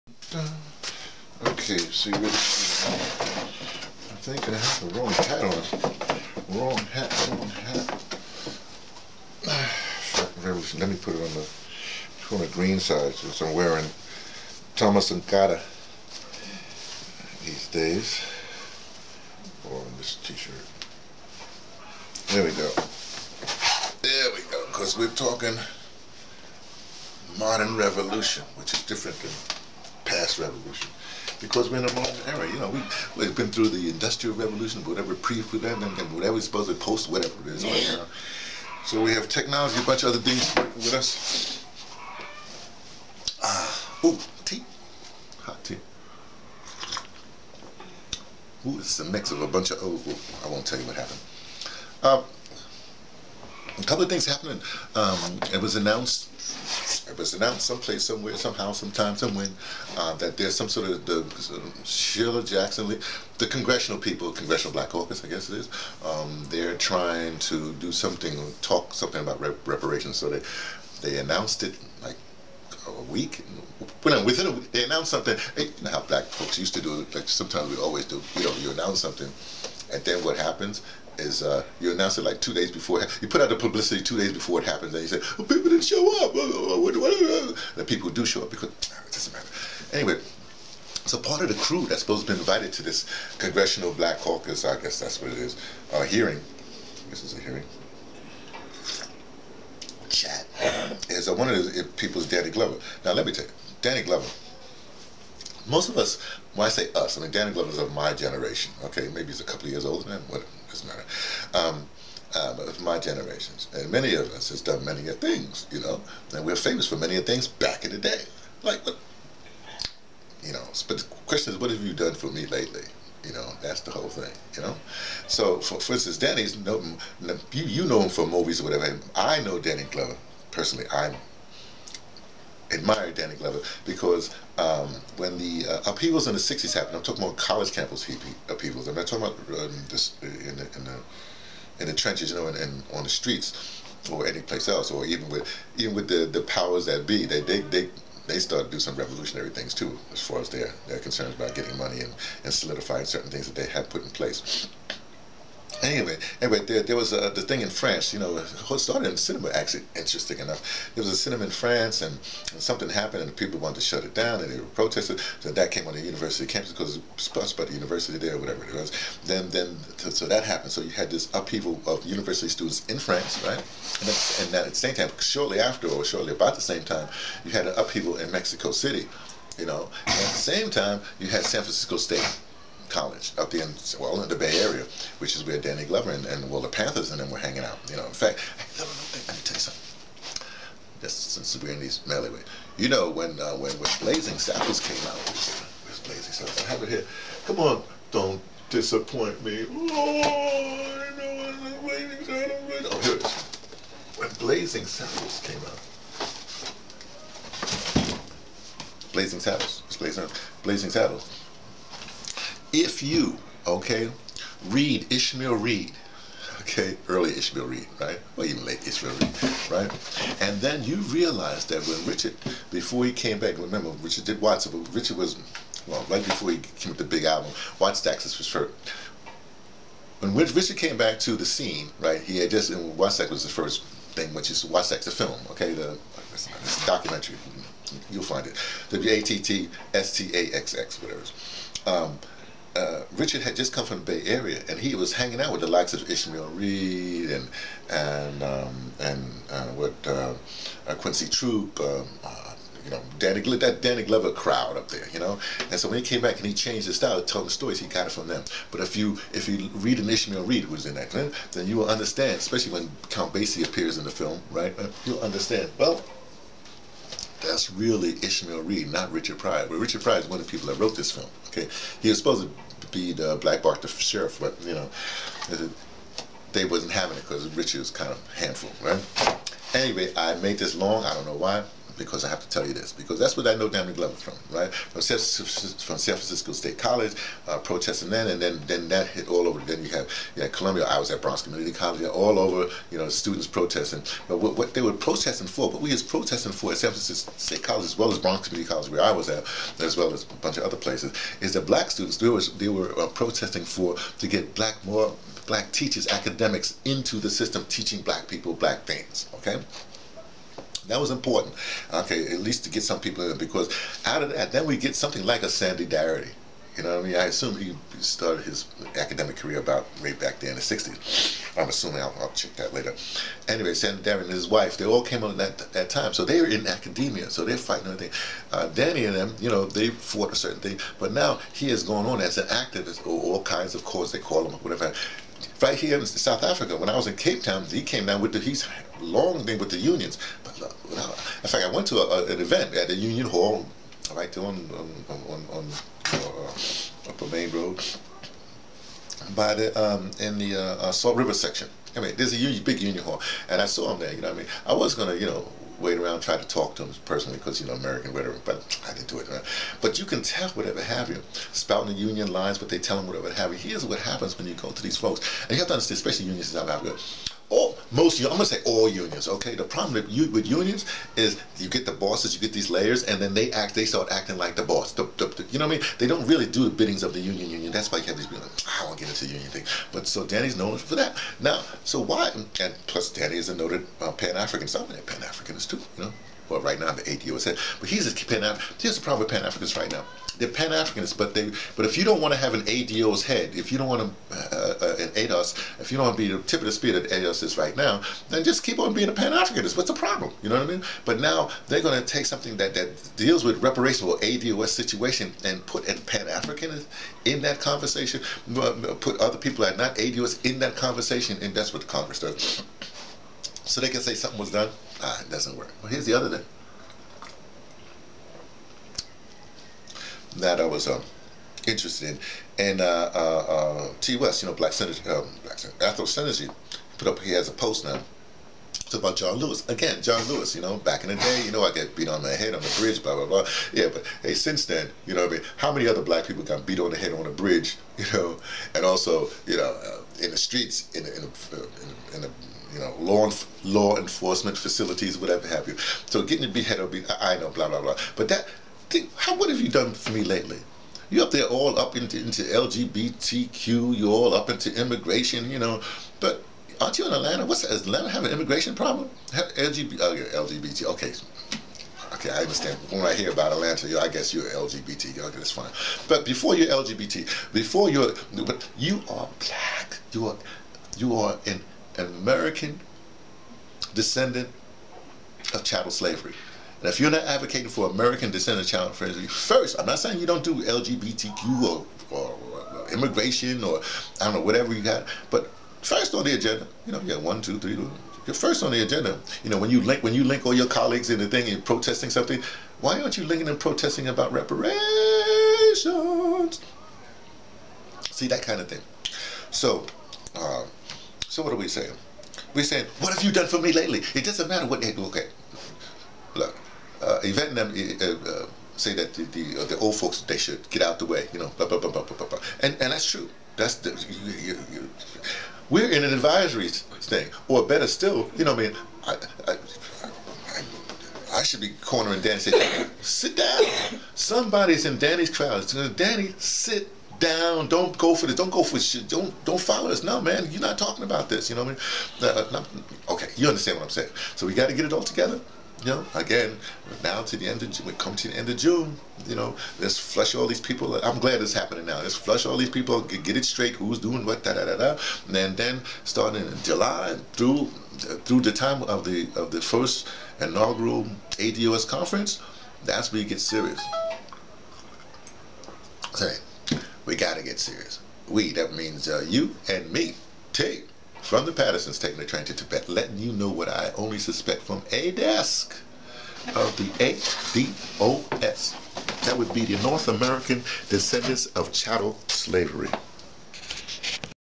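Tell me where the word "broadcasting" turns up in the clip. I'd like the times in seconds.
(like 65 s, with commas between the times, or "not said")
not said.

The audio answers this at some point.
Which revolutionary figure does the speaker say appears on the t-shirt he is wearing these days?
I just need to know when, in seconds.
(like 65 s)
14 s.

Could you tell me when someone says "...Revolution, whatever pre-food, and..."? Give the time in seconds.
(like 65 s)
34 s.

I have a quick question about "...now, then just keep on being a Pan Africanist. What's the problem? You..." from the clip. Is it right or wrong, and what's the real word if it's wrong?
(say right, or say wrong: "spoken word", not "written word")
right.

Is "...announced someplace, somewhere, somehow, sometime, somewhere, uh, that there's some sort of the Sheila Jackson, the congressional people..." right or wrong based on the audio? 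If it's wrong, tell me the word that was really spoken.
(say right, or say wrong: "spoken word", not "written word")
right.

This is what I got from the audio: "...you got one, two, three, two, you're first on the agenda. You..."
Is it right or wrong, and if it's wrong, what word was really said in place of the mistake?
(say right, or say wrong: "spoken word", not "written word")
right.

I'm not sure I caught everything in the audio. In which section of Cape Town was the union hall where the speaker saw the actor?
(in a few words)
Salt River.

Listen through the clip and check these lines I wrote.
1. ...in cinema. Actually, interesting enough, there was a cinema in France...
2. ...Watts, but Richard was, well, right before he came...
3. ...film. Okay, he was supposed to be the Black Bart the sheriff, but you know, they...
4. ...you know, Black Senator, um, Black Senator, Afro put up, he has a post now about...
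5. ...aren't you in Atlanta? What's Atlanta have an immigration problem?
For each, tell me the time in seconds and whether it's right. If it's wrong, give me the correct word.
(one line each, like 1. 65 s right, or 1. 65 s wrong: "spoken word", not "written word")
1. 159 s right
2. 224 s right
3. 271 s right
4. 424 s right
5. 456 s right.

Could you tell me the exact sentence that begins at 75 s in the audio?
You know how black folks used to do, it.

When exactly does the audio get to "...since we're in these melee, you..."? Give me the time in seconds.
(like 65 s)
191 s.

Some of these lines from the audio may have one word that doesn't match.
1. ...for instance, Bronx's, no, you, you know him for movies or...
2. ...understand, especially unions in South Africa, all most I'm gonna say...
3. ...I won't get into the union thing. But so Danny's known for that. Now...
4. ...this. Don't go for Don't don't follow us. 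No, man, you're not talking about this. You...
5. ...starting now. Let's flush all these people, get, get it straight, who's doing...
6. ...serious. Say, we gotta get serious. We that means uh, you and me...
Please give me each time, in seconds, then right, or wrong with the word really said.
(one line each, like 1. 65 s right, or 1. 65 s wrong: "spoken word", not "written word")
1. 125 s wrong: "Danny", not "Bronx"
2. 365 s right
3. 378 s right
4. 528 s right
5. 541 s wrong: "happening", not "starting"
6. 553 s right.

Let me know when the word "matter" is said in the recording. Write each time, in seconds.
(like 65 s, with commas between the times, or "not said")
89 s, 110 s, 504 s.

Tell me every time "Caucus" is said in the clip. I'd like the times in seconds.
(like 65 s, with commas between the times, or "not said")
64 s, 94 s.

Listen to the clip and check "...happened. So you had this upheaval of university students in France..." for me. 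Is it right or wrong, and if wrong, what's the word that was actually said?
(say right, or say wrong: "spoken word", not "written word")
right.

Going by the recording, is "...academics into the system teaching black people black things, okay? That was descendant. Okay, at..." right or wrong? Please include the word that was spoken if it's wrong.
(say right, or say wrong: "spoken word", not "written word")
wrong: "important", not "descendant".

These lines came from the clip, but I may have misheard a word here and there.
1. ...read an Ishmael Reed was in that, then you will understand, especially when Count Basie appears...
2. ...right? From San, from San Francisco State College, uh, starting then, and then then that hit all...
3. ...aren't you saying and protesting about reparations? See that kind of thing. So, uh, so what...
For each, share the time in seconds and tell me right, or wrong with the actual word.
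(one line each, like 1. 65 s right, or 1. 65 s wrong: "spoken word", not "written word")
1. 259 s right
2. 284 s wrong: "protesting", not "starting"
3. 493 s wrong: "linking", not "saying".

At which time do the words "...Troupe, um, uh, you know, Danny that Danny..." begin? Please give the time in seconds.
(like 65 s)
251 s.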